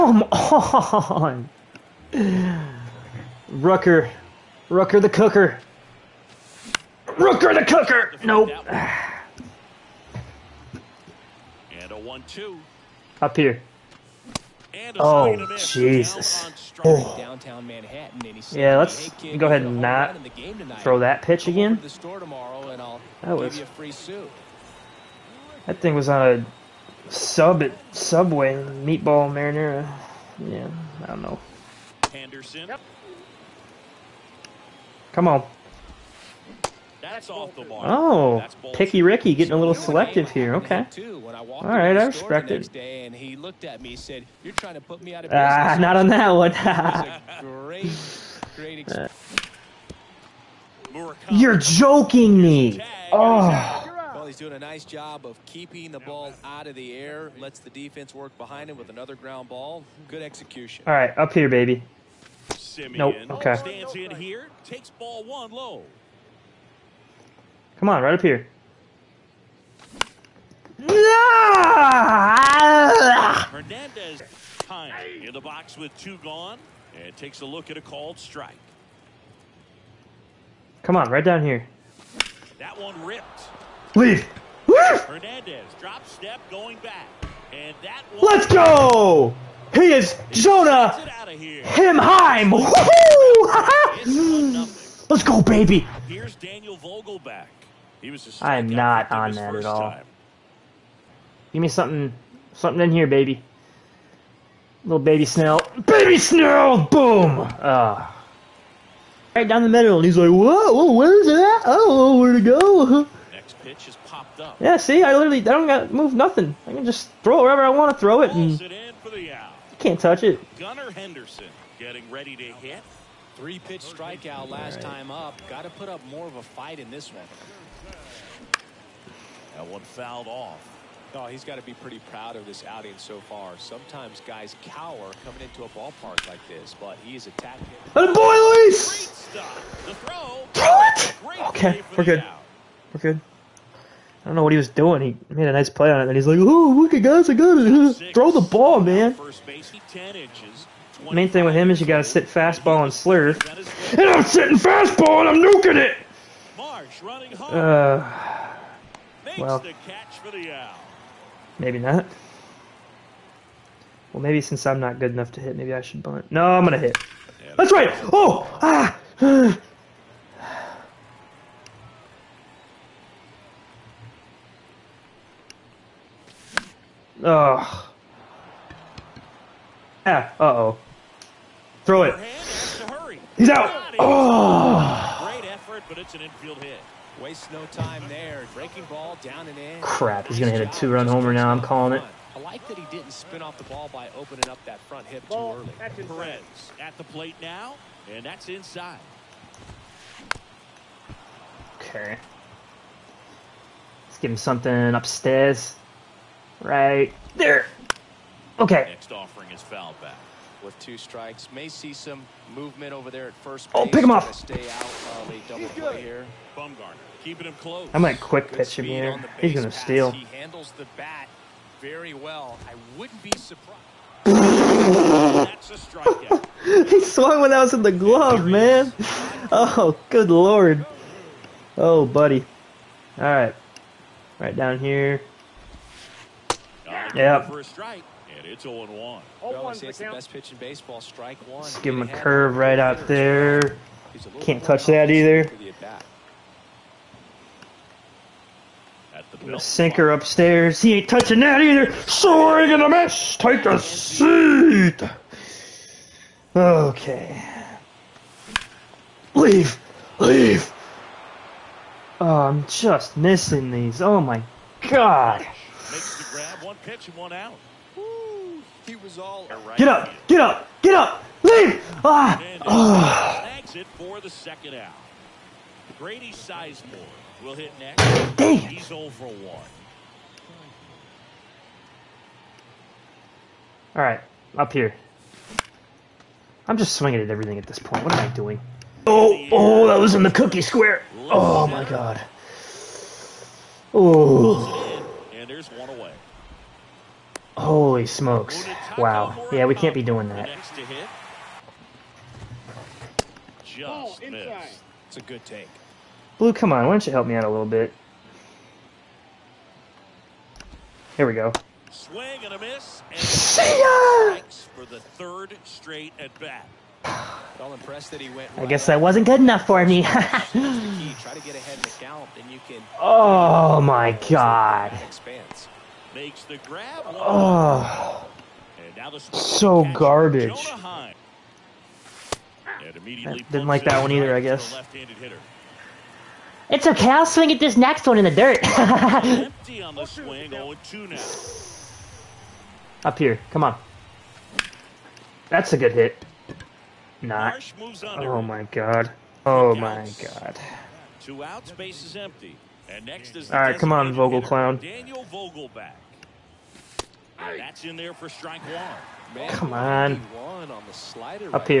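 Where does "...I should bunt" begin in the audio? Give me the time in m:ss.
2:45.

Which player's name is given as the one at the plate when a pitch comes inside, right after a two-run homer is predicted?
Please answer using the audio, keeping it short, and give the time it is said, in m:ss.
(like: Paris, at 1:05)
Perez, at 3:15.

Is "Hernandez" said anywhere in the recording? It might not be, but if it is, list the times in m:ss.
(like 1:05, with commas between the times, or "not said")
1:13, 1:25.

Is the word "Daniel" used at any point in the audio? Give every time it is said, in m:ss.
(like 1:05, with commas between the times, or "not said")
1:36, 5:54.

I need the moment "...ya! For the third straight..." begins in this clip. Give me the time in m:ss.
5:13.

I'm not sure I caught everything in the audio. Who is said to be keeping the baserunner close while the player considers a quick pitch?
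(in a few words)
Bumgarner.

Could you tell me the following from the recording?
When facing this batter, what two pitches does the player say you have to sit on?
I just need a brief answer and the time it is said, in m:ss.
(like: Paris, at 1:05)
fastball and slurve, at 2:32.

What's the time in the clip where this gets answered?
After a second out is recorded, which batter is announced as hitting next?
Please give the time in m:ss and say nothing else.
4:35.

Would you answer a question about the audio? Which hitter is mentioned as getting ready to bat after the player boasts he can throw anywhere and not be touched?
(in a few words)
Gunnar Henderson.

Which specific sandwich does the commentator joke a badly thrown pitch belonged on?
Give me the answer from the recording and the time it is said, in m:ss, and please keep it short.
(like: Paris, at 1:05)
meatball marinara, at 0:28.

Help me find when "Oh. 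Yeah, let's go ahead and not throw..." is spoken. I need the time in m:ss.
0:16.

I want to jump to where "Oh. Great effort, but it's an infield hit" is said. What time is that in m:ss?
3:03.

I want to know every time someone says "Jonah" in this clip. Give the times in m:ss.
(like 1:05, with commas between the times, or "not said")
1:30.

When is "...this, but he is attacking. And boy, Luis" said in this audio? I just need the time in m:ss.
2:16.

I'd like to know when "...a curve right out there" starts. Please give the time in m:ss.
4:02.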